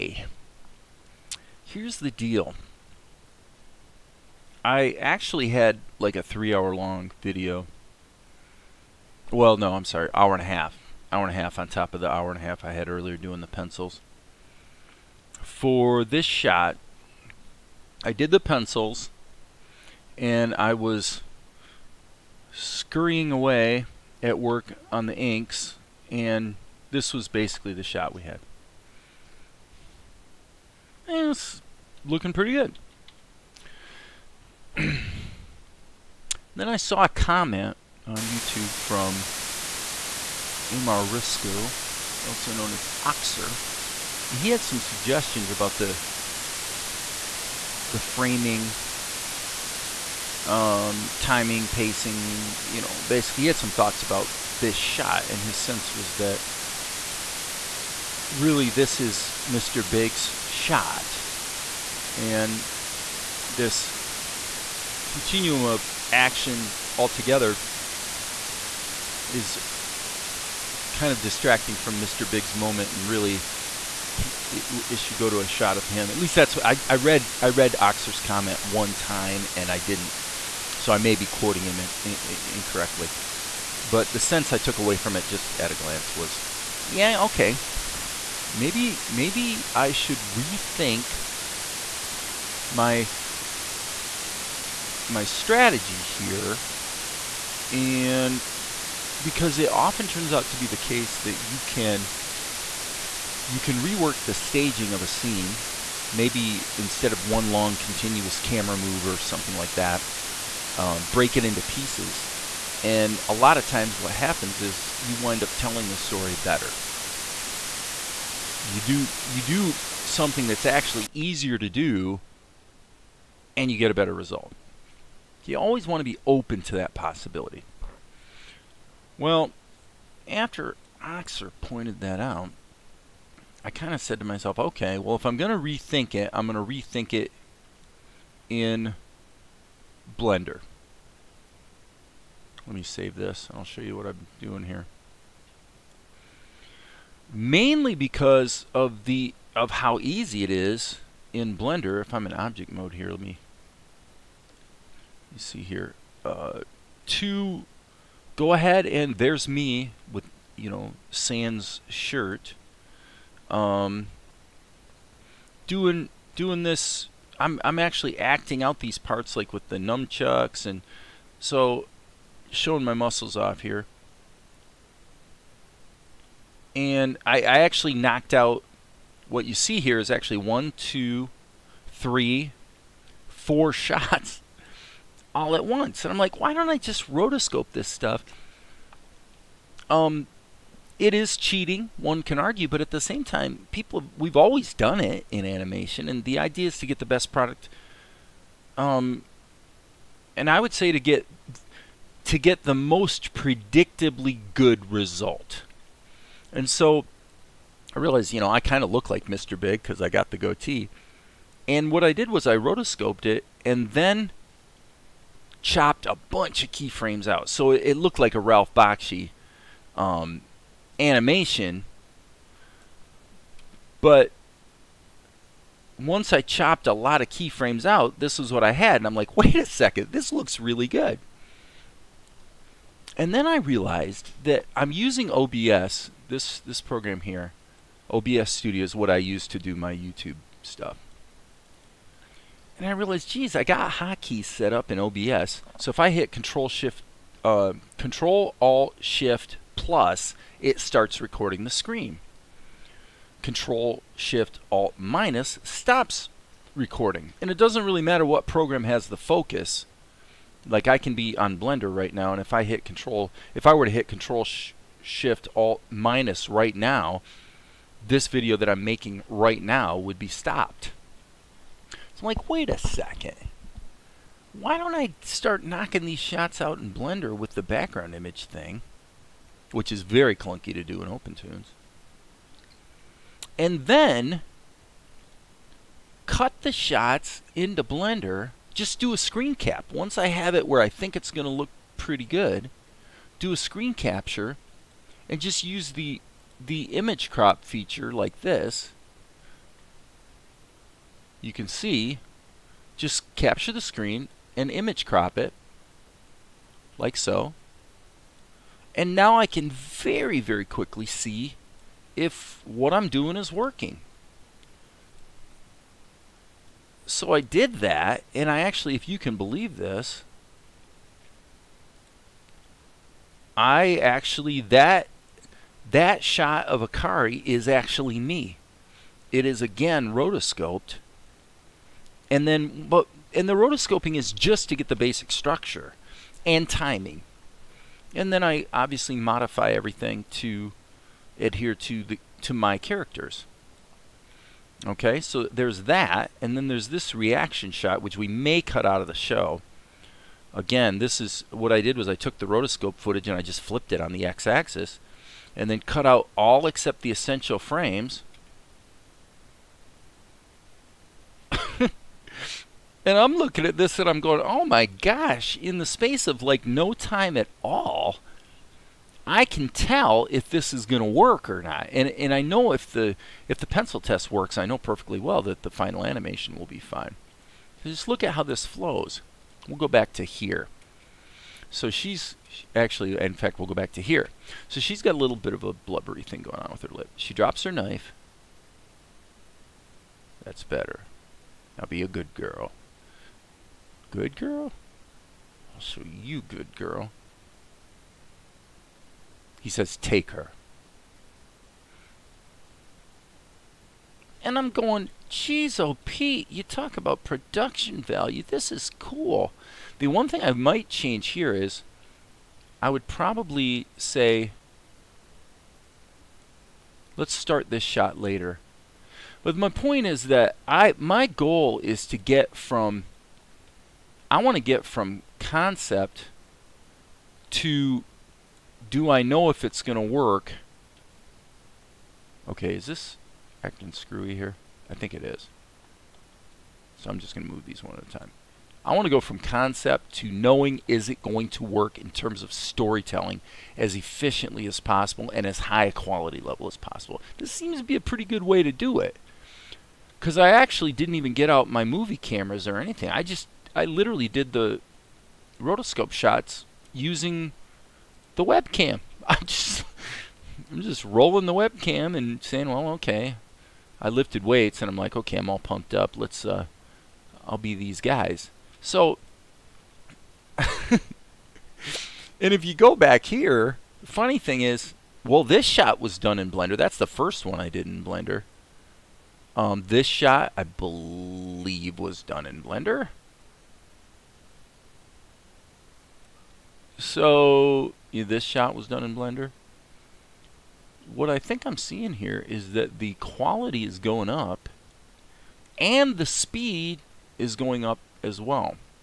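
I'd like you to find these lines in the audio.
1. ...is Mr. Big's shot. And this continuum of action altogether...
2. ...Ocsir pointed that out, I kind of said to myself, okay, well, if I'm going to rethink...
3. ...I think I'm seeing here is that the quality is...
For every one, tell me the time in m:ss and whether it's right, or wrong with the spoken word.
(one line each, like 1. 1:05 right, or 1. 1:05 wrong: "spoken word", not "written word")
1. 0:58 right
2. 2:11 right
3. 8:11 right.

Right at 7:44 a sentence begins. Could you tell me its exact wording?
I lifted weights and I'm like, okay, I'm all pumped up.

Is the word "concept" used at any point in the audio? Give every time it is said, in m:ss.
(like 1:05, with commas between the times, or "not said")
7:05, 7:19.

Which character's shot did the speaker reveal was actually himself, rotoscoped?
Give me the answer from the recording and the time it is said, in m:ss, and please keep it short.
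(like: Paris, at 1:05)
Akari, at 5:26.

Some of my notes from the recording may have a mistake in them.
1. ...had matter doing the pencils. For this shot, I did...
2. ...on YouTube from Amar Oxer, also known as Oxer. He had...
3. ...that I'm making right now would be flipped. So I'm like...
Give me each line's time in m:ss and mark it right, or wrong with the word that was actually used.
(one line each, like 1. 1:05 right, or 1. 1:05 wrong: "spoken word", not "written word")
1. 0:12 wrong: "earlier", not "matter"
2. 0:38 wrong: "Risco", not "Oxer"
3. 4:28 wrong: "stopped", not "flipped".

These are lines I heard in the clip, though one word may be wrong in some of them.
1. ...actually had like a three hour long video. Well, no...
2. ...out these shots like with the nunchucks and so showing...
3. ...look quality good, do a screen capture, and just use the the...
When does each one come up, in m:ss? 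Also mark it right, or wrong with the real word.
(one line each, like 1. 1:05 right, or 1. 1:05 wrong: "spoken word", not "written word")
1. 0:04 right
2. 2:48 wrong: "parts", not "shots"
3. 4:51 wrong: "pretty", not "quality".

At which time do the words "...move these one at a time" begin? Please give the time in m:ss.
7:17.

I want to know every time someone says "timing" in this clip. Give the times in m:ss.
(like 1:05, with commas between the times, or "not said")
0:51, 5:36.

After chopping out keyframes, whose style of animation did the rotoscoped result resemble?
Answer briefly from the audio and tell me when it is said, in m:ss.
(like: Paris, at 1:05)
Ralph Bakshi, at 3:38.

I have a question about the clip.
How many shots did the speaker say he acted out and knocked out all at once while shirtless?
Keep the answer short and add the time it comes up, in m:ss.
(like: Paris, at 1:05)
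4, at 3:03.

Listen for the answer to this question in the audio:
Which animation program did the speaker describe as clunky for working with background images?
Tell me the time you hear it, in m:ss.
4:41.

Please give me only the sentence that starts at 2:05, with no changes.
You always want to be open to that possibility.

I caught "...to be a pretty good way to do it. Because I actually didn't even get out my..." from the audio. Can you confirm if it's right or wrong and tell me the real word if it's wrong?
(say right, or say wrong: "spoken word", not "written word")
right.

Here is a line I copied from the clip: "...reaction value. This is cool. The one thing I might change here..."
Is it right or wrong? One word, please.
wrong.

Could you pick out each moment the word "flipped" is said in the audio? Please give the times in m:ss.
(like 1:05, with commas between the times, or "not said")
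5:53.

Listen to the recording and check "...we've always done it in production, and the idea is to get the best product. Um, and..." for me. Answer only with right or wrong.
wrong.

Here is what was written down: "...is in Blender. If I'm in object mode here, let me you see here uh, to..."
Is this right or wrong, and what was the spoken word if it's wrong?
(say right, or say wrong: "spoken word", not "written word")
right.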